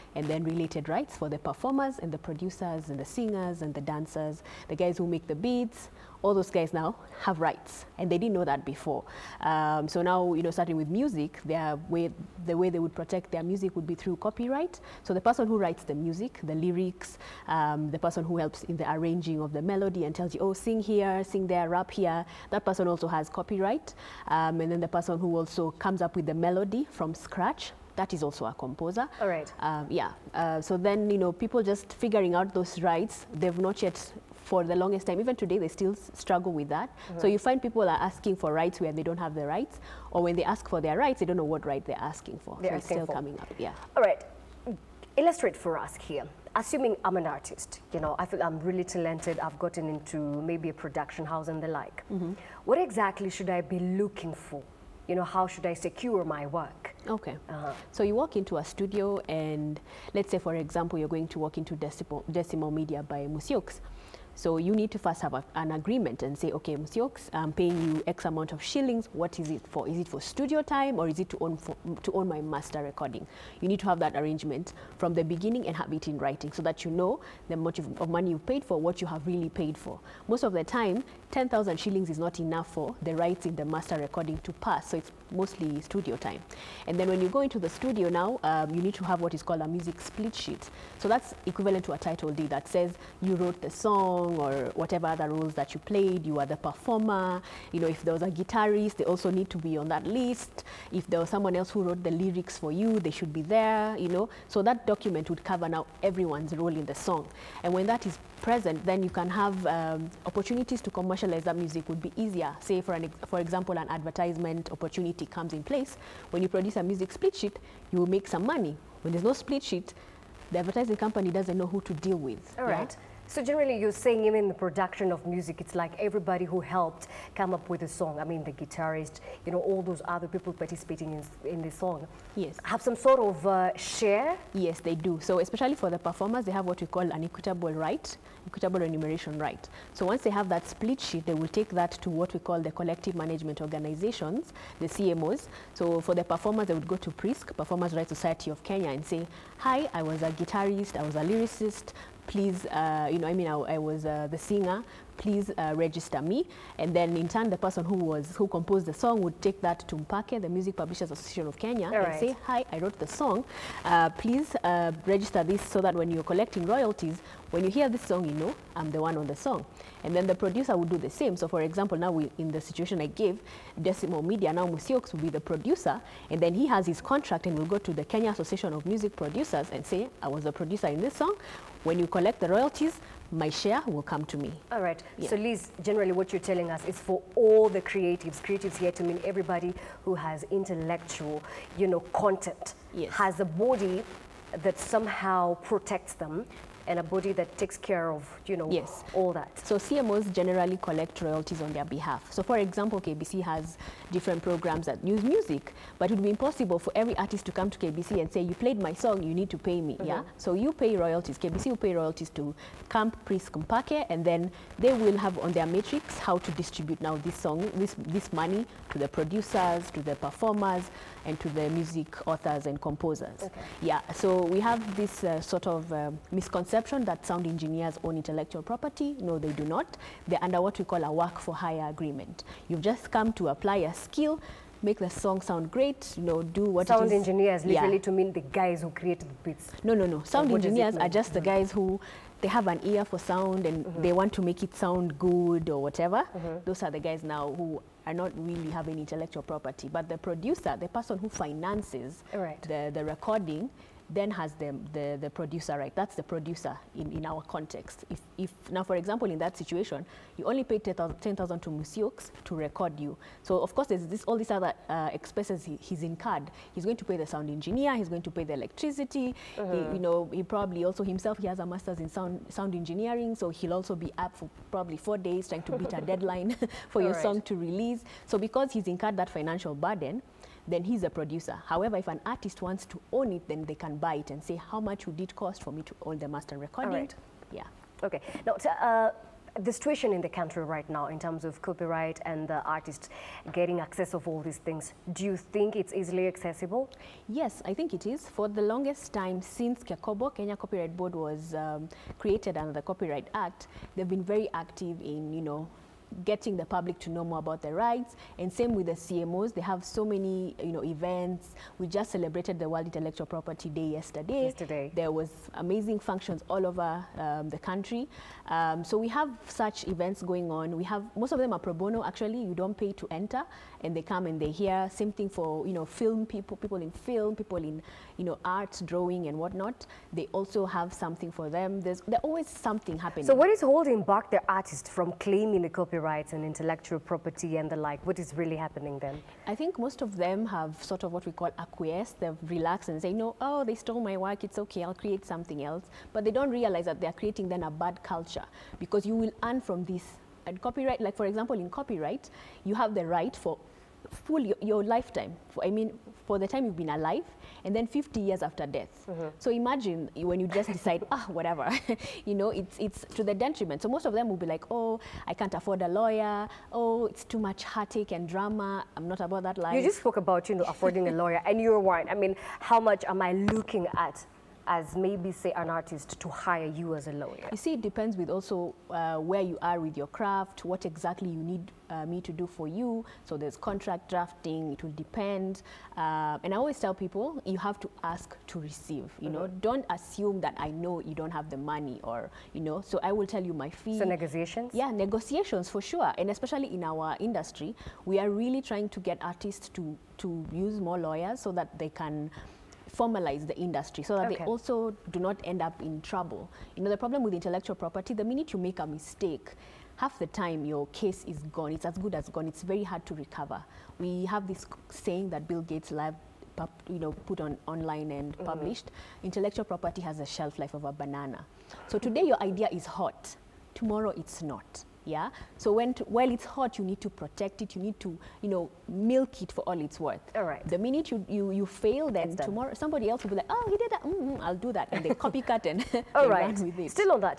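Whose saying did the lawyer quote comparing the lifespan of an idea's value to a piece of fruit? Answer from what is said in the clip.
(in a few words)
Bill Gates.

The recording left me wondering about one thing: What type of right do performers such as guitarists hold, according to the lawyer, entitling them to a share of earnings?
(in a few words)
Equitable remuneration right.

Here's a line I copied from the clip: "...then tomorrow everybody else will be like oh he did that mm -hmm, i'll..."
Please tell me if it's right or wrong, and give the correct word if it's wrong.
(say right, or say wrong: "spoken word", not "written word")
wrong: "somebody", not "everybody".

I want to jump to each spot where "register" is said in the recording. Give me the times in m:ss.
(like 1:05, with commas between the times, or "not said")
2:35, 2:45.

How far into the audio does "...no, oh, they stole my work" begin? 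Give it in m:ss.
5:43.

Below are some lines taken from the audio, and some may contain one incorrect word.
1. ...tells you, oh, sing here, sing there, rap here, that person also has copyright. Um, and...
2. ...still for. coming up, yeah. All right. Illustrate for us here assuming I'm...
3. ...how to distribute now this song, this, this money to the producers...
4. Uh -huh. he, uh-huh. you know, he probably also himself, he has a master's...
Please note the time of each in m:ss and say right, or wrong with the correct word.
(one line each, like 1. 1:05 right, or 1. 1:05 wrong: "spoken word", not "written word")
1. 0:20 right
2. 0:42 right
3. 3:36 right
4. 4:29 right.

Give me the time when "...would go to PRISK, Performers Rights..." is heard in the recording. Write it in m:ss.
2:26.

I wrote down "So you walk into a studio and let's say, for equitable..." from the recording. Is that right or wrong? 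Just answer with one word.
wrong.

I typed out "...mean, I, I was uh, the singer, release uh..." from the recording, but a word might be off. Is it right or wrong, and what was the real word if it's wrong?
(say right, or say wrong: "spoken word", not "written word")
wrong: "please", not "release".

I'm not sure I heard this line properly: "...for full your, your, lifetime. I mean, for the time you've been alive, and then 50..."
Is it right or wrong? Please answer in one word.
right.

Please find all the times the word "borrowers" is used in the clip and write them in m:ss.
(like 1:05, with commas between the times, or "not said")
not said.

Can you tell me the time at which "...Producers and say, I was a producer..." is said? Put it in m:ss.
2:59.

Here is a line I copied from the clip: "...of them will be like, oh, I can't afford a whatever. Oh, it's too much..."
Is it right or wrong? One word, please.
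wrong.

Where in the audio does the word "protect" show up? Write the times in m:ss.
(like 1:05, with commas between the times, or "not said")
0:12, 3:15, 7:07.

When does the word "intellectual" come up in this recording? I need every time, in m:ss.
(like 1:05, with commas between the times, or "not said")
3:10, 3:48, 4:08, 5:12, 5:36, 6:47, 6:59.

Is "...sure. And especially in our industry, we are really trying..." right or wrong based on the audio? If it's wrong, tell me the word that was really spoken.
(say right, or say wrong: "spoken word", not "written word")
right.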